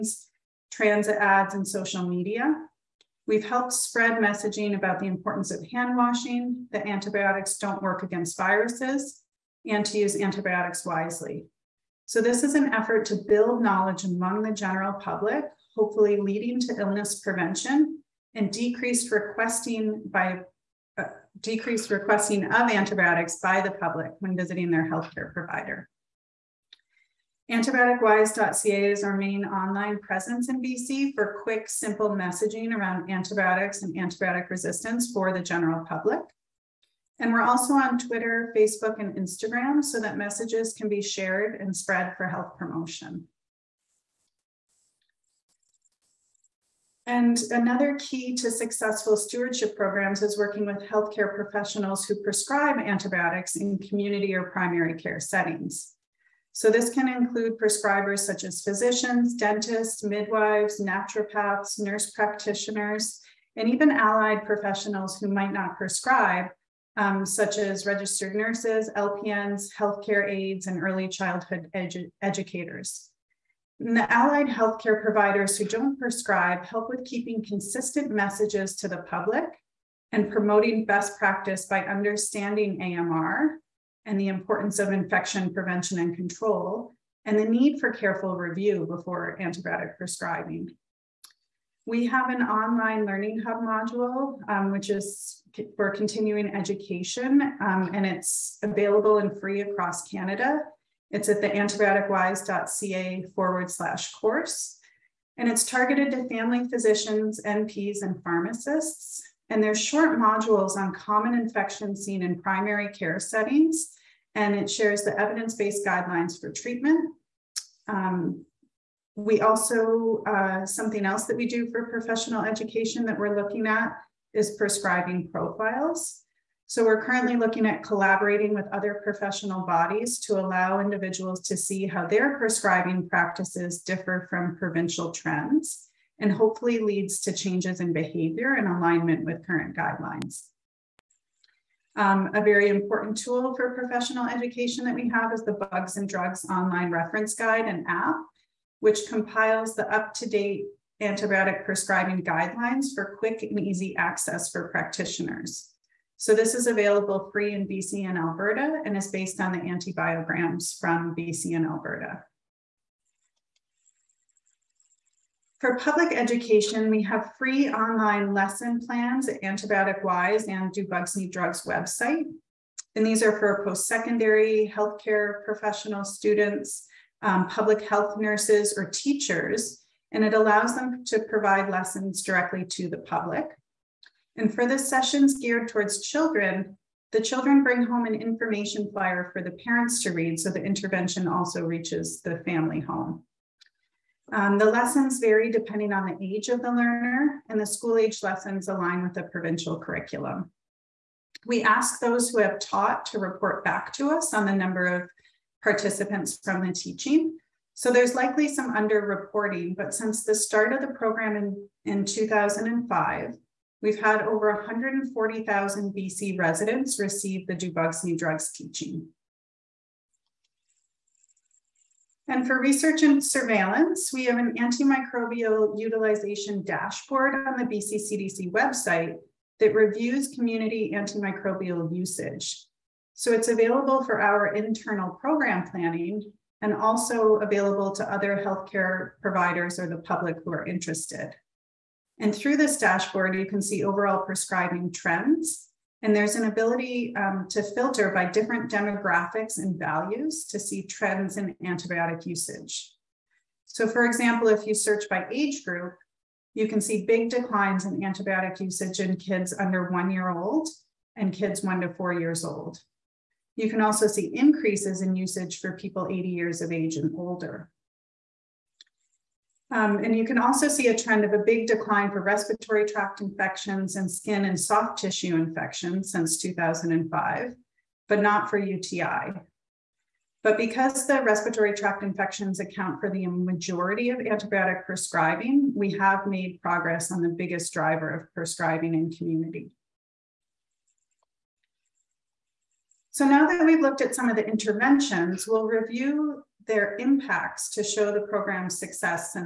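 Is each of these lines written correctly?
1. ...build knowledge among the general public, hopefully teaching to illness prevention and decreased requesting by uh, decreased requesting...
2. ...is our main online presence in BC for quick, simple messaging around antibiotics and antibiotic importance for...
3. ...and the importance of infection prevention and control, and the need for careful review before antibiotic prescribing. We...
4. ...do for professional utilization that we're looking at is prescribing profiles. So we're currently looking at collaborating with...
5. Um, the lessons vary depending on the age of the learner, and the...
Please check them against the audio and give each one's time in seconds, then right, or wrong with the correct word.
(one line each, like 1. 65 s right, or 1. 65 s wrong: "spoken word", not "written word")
1. 13 s wrong: "leading", not "teaching"
2. 28 s wrong: "resistance", not "importance"
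3. 84 s right
4. 121 s wrong: "education", not "utilization"
5. 194 s right.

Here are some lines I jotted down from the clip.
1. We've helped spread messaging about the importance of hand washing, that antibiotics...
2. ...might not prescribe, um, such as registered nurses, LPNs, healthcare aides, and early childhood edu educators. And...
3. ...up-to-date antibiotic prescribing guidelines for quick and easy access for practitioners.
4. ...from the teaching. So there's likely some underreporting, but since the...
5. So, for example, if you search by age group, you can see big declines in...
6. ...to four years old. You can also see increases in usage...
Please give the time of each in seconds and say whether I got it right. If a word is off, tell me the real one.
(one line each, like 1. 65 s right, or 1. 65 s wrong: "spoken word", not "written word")
1. 3 s right
2. 65 s right
3. 149 s right
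4. 206 s right
5. 253 s right
6. 261 s right.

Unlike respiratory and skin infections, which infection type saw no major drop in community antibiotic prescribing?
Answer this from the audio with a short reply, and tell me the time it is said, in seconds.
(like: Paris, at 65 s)
UTI, at 278 s.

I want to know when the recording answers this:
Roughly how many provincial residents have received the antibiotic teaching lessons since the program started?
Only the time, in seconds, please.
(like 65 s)
214 s.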